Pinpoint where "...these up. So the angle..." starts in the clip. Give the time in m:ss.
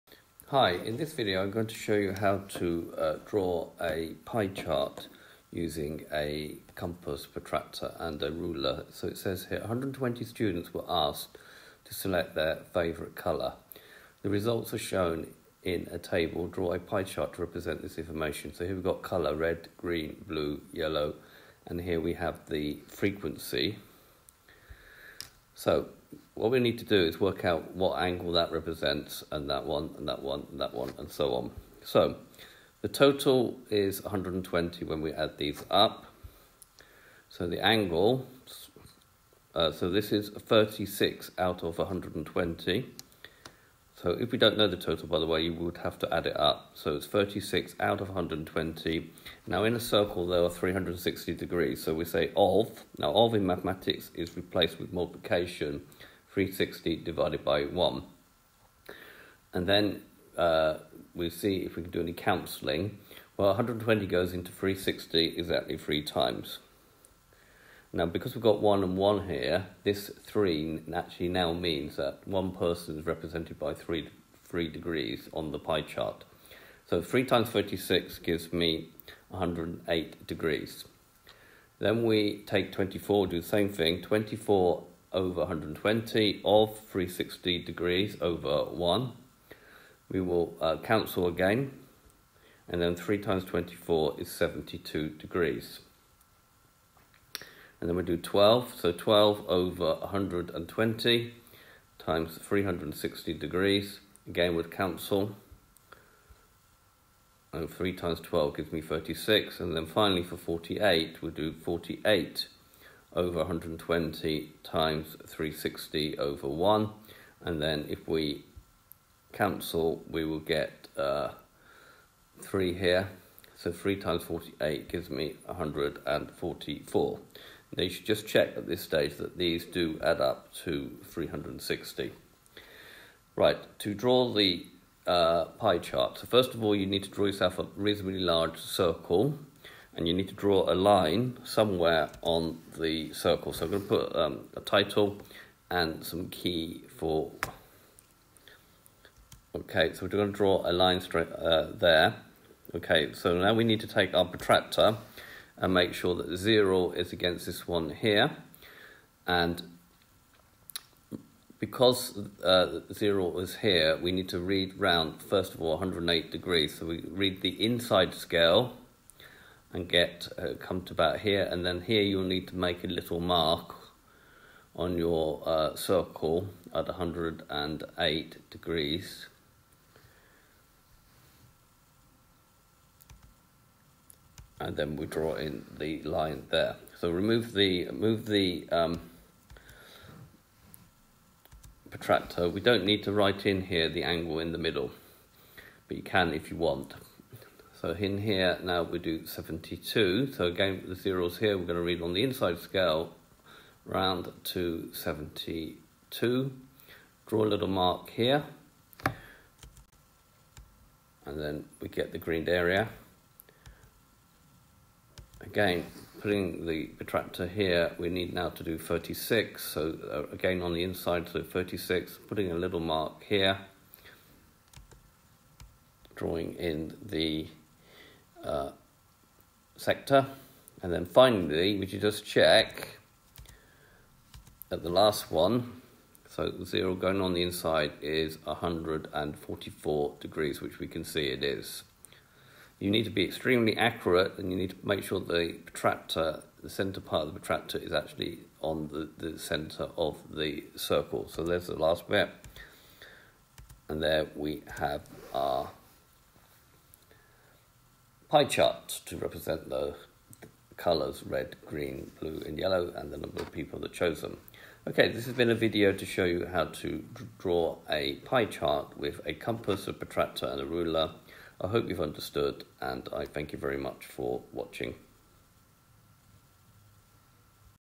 0:35.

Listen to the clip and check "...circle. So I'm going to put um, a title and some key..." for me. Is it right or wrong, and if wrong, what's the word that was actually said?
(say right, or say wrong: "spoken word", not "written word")
right.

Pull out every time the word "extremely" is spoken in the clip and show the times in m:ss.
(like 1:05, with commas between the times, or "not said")
4:03.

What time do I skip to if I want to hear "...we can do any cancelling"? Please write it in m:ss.
1:01.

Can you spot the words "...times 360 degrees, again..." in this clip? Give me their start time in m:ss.
1:41.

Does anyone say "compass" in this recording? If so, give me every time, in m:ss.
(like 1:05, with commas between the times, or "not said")
0:06, 4:29.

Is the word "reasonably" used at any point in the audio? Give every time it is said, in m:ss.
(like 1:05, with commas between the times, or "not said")
2:17.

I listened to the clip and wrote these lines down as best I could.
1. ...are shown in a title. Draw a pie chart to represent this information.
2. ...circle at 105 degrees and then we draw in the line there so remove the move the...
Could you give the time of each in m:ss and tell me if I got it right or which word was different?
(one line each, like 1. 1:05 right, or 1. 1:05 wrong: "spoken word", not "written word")
1. 0:14 wrong: "table", not "title"
2. 2:55 wrong: "108", not "105".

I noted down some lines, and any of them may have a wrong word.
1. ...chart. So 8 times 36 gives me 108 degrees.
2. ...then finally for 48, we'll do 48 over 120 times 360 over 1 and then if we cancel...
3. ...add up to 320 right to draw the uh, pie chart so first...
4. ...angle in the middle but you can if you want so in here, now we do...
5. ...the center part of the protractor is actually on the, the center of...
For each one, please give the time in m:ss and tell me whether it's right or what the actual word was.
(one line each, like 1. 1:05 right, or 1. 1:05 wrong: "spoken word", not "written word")
1. 1:15 wrong: "3", not "8"
2. 1:49 right
3. 2:10 wrong: "360", not "320"
4. 3:14 right
5. 4:06 right.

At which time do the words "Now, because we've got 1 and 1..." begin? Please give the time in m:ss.
1:07.